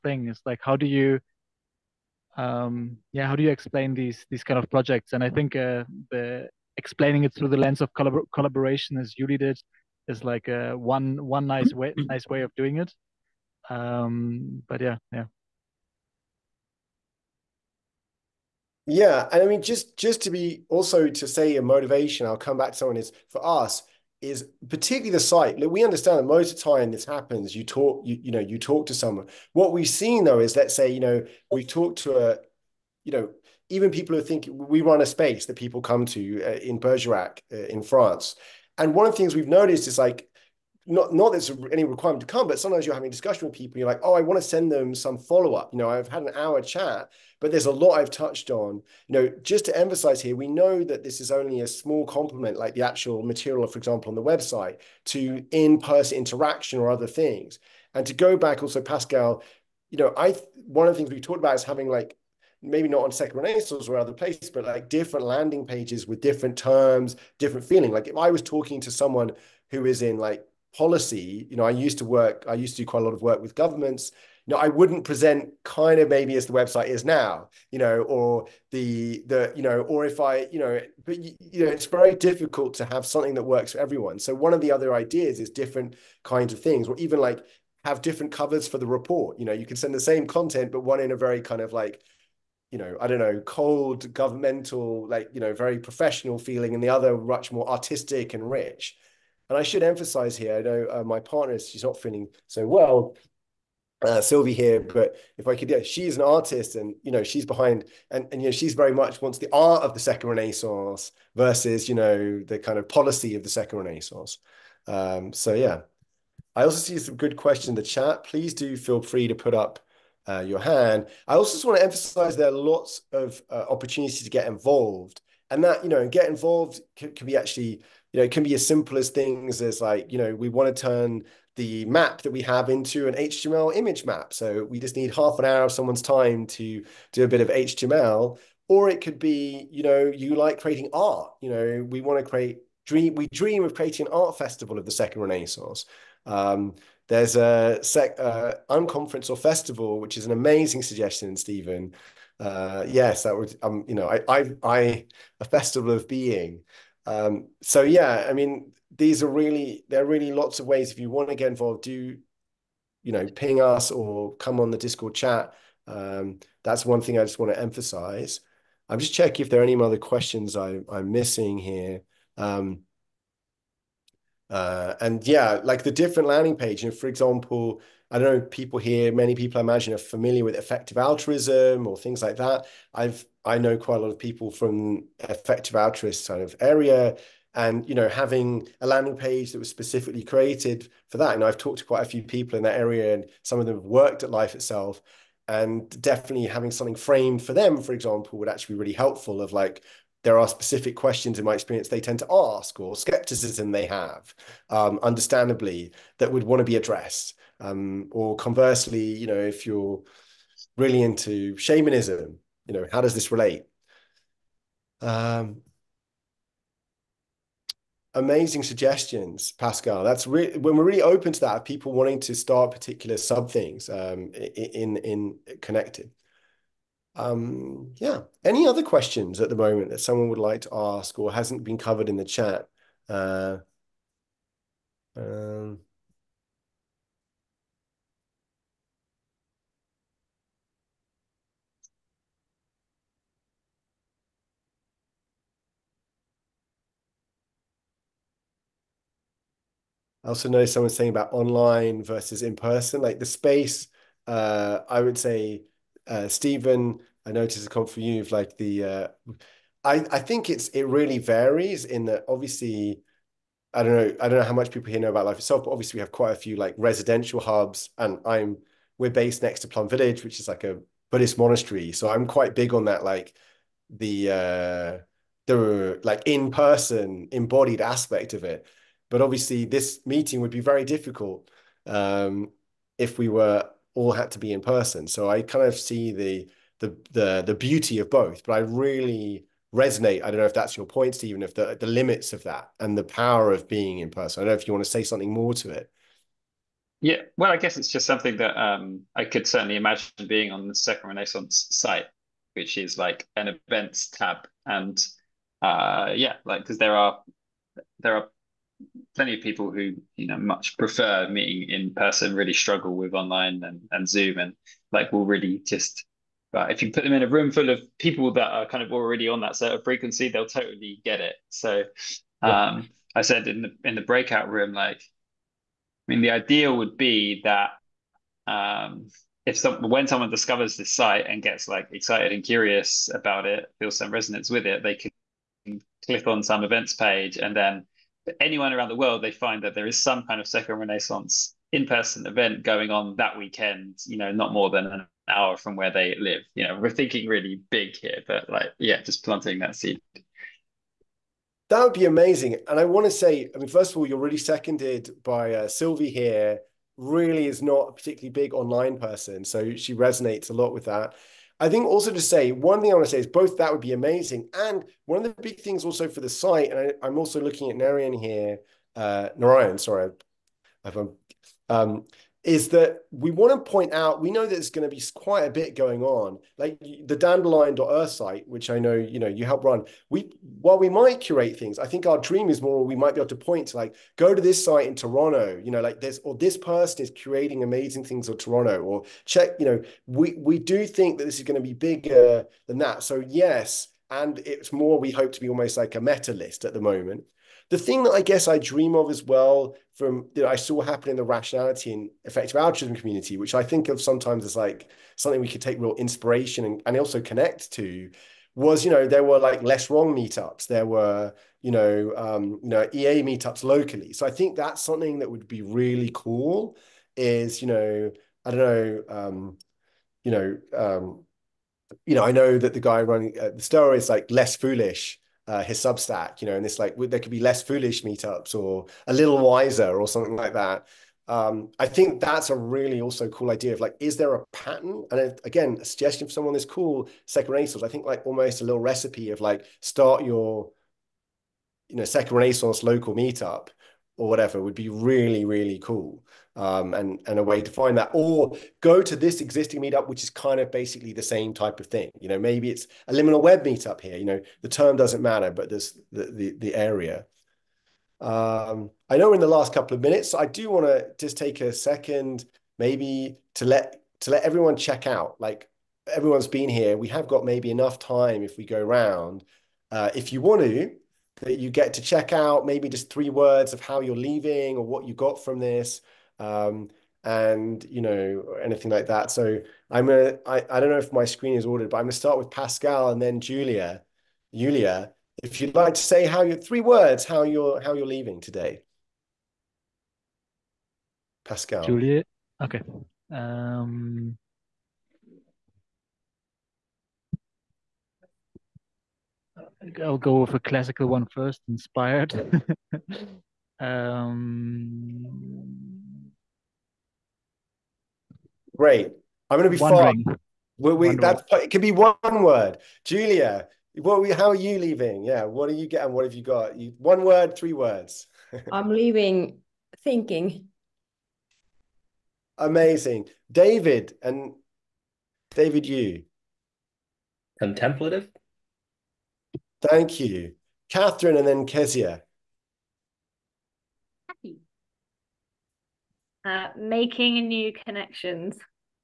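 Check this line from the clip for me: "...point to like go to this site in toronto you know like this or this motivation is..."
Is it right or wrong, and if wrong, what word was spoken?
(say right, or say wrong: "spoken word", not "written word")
wrong: "person", not "motivation".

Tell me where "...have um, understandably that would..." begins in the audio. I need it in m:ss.
3:23.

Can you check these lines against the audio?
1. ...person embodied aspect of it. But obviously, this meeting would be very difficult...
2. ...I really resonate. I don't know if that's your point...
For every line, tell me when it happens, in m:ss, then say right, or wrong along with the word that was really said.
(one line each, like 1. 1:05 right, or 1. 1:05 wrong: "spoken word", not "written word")
1. 4:36 right
2. 4:48 right.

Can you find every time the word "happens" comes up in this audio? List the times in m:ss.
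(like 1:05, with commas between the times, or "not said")
0:27, 6:40.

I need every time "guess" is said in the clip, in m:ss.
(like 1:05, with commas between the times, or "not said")
4:57, 6:38.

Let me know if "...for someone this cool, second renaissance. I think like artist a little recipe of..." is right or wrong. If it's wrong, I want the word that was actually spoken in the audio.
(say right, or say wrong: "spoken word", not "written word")
wrong: "almost", not "artist".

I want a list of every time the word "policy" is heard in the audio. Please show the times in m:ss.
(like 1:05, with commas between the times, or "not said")
1:10, 1:52.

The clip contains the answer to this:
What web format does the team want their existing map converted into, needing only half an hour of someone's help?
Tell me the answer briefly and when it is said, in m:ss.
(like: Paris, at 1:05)
HTML image map, at 2:13.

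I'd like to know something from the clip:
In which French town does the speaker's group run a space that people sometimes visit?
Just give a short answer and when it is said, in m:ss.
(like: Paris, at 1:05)
Bergerac, at 0:36.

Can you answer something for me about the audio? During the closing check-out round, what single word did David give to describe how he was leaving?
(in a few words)
Contemplative.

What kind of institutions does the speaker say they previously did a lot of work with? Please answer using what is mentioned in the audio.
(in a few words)
governments.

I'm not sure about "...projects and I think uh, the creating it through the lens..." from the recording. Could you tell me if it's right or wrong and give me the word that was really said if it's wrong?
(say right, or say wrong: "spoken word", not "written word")
wrong: "explaining", not "creating".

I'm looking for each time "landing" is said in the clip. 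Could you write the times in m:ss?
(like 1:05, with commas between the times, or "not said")
1:05, 2:56, 3:08.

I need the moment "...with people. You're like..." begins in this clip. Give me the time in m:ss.
0:43.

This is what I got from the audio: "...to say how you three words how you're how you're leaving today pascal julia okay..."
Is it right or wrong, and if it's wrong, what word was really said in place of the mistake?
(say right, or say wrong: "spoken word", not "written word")
right.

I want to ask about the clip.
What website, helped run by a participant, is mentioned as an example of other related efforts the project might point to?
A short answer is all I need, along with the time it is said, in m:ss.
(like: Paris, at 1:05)
dandelion.earth, at 6:17.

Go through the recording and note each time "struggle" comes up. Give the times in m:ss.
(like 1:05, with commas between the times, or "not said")
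5:12.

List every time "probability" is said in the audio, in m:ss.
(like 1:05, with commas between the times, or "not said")
not said.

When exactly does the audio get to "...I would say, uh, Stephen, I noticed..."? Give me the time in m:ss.
4:14.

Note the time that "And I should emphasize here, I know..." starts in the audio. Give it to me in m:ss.
1:39.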